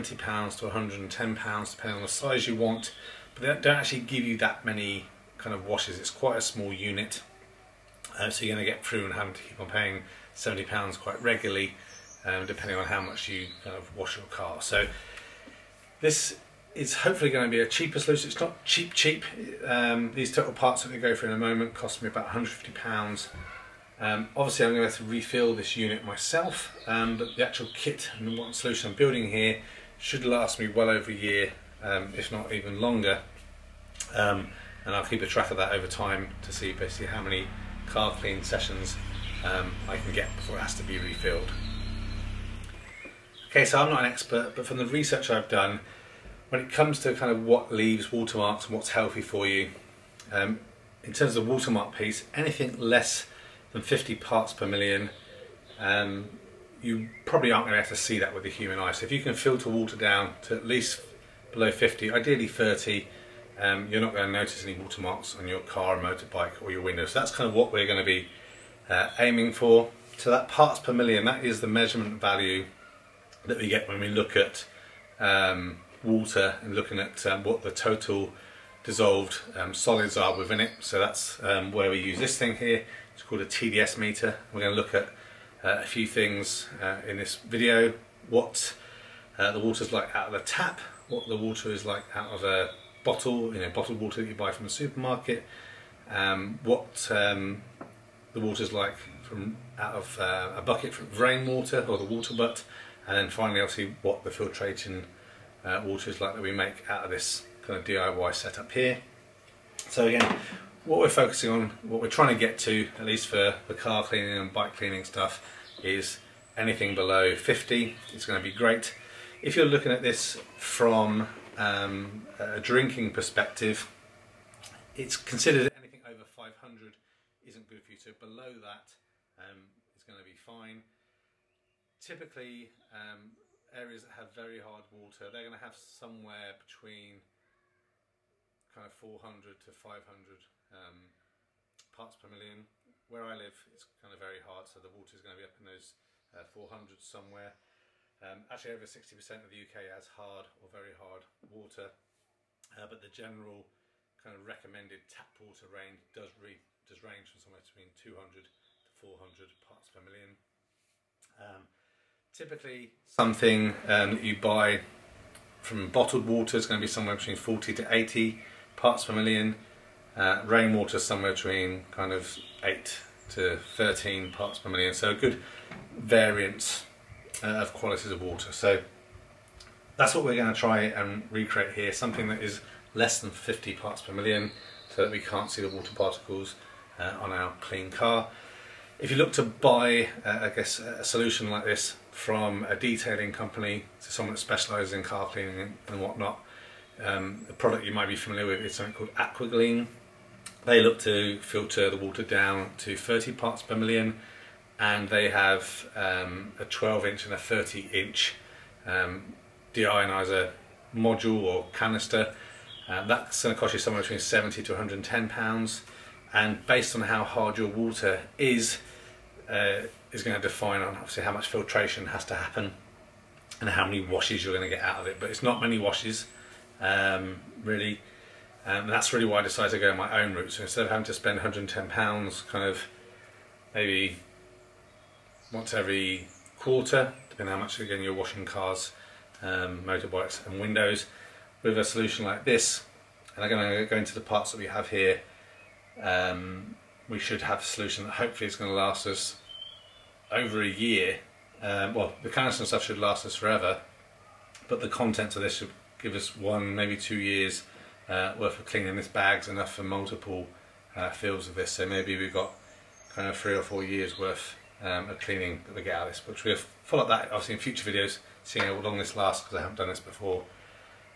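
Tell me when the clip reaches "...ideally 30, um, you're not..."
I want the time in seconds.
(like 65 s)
62 s.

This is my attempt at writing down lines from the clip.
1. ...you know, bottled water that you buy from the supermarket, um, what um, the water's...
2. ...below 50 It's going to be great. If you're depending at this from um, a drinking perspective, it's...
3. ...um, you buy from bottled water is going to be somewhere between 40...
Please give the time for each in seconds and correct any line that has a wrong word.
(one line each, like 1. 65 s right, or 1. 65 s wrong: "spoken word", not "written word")
1. 93 s right
2. 116 s wrong: "looking", not "depending"
3. 163 s right.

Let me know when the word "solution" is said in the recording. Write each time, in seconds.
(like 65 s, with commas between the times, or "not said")
17 s, 28 s, 191 s, 241 s, 247 s.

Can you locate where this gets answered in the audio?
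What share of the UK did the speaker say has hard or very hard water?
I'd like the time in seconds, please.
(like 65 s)
148 s.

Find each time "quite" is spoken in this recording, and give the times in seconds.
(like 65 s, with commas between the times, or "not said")
6 s, 10 s.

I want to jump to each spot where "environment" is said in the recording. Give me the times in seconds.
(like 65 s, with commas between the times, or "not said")
not said.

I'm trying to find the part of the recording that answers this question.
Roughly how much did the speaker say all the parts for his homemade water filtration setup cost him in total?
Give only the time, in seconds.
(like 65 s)
22 s.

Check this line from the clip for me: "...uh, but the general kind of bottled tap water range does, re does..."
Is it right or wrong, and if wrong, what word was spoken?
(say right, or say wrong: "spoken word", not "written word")
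wrong: "recommended", not "bottled".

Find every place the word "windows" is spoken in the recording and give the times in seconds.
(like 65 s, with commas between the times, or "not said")
66 s, 240 s.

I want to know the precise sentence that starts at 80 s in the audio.
So that's um, where we use this thing here.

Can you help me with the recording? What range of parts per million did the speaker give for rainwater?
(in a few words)
8 to 13.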